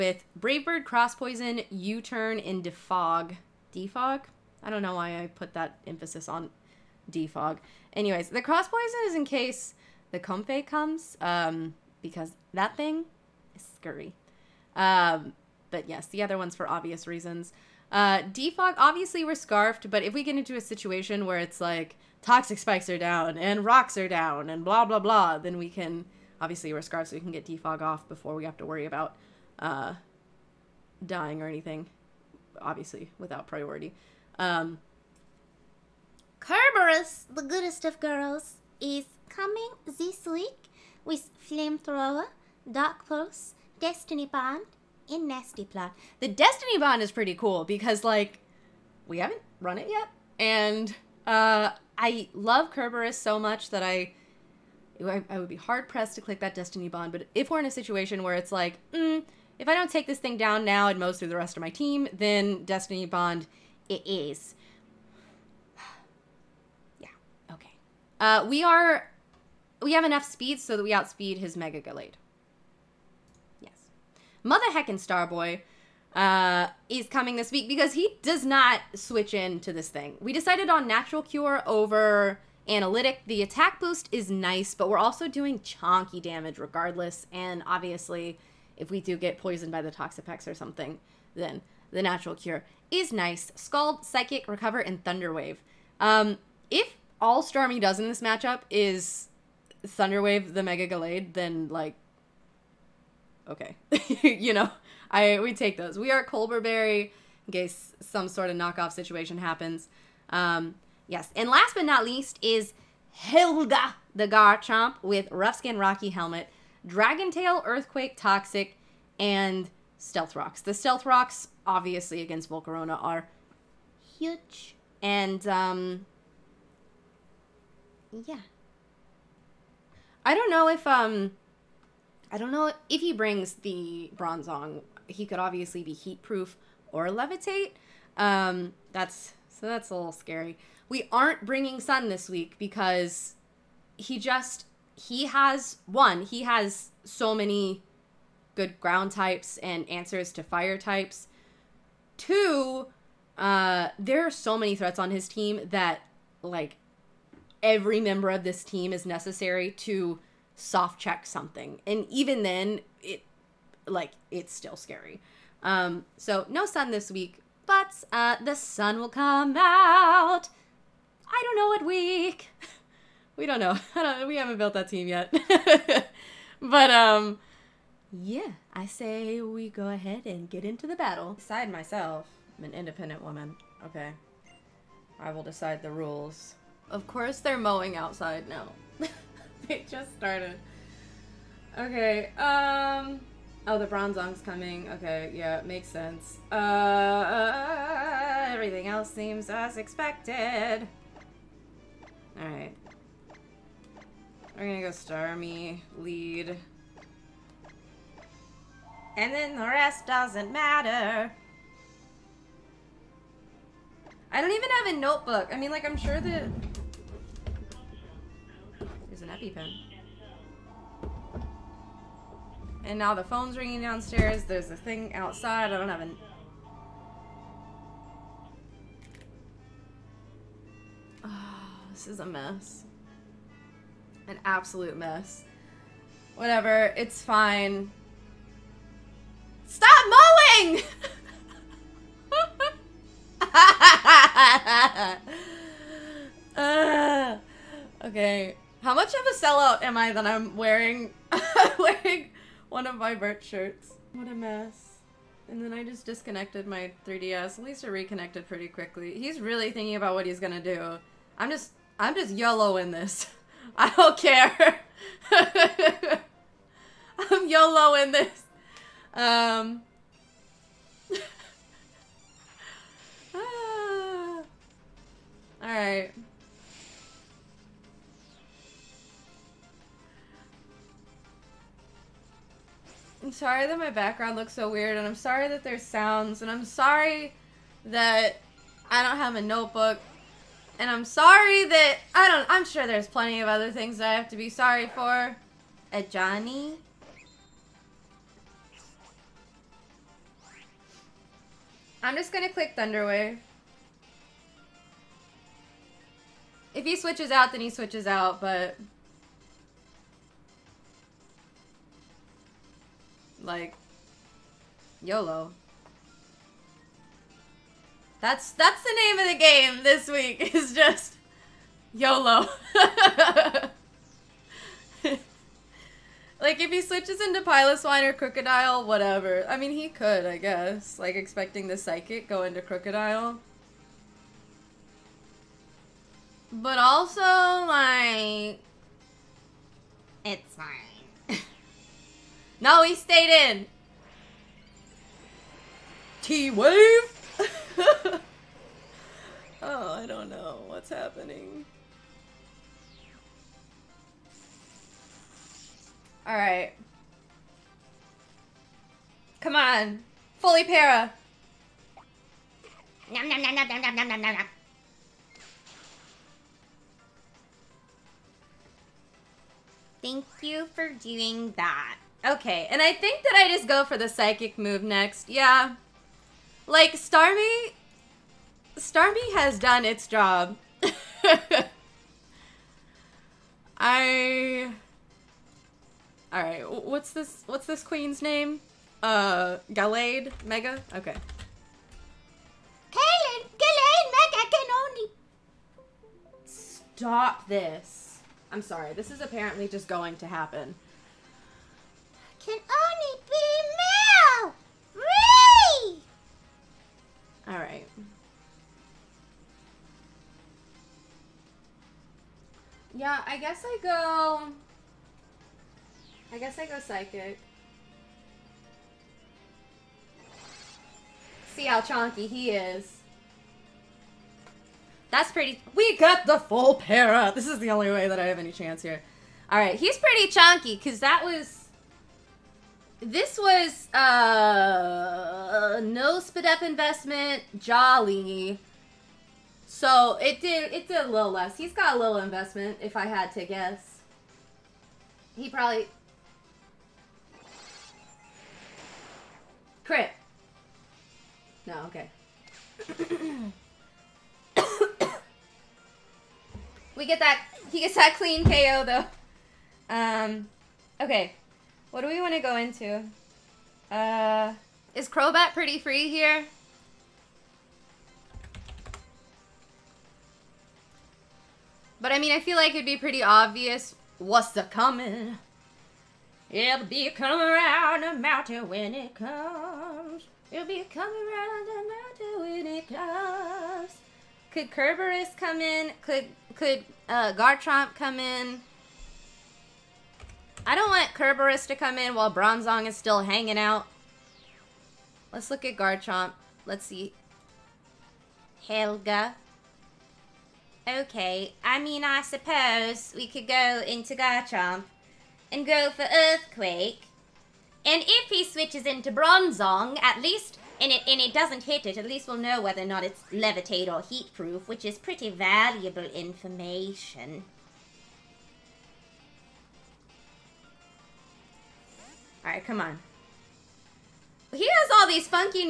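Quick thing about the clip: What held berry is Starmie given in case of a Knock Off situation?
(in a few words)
Colbur Berry.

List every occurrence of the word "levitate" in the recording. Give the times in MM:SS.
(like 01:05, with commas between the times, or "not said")
02:17, 08:33.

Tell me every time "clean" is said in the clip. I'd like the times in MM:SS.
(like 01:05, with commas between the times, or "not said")
07:38.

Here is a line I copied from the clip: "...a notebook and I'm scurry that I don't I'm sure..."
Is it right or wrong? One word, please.
wrong.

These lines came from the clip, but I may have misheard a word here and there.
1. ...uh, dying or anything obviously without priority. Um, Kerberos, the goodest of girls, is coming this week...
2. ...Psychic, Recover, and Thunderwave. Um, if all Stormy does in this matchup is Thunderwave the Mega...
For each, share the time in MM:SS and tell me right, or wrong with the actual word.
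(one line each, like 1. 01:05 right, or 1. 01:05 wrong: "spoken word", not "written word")
1. 00:29 right
2. 01:34 right.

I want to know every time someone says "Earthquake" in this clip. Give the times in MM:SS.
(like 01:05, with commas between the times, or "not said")
01:57, 08:26.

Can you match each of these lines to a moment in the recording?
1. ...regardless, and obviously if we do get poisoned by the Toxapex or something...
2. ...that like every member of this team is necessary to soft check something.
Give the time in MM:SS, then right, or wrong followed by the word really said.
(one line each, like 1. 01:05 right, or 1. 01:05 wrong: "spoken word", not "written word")
1. 01:26 right
2. 02:35 right.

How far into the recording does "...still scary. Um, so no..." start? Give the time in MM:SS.
02:44.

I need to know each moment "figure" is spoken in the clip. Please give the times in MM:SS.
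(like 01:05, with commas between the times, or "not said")
not said.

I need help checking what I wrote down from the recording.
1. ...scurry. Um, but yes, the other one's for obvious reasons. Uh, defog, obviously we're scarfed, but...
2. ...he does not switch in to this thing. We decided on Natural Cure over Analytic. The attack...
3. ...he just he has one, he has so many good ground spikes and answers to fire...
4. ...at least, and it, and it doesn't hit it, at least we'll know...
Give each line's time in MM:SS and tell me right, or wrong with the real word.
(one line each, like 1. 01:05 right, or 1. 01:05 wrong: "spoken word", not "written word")
1. 00:13 right
2. 01:17 right
3. 02:23 wrong: "types", not "spikes"
4. 08:30 right.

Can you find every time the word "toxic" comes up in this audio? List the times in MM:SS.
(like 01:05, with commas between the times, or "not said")
00:22, 01:58.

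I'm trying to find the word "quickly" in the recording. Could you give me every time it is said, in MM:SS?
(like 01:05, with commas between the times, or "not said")
04:18.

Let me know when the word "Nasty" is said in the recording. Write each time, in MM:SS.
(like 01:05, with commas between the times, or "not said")
00:45.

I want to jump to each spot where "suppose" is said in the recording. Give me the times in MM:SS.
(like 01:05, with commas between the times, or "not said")
08:22.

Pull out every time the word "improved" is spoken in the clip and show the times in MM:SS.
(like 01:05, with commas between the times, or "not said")
not said.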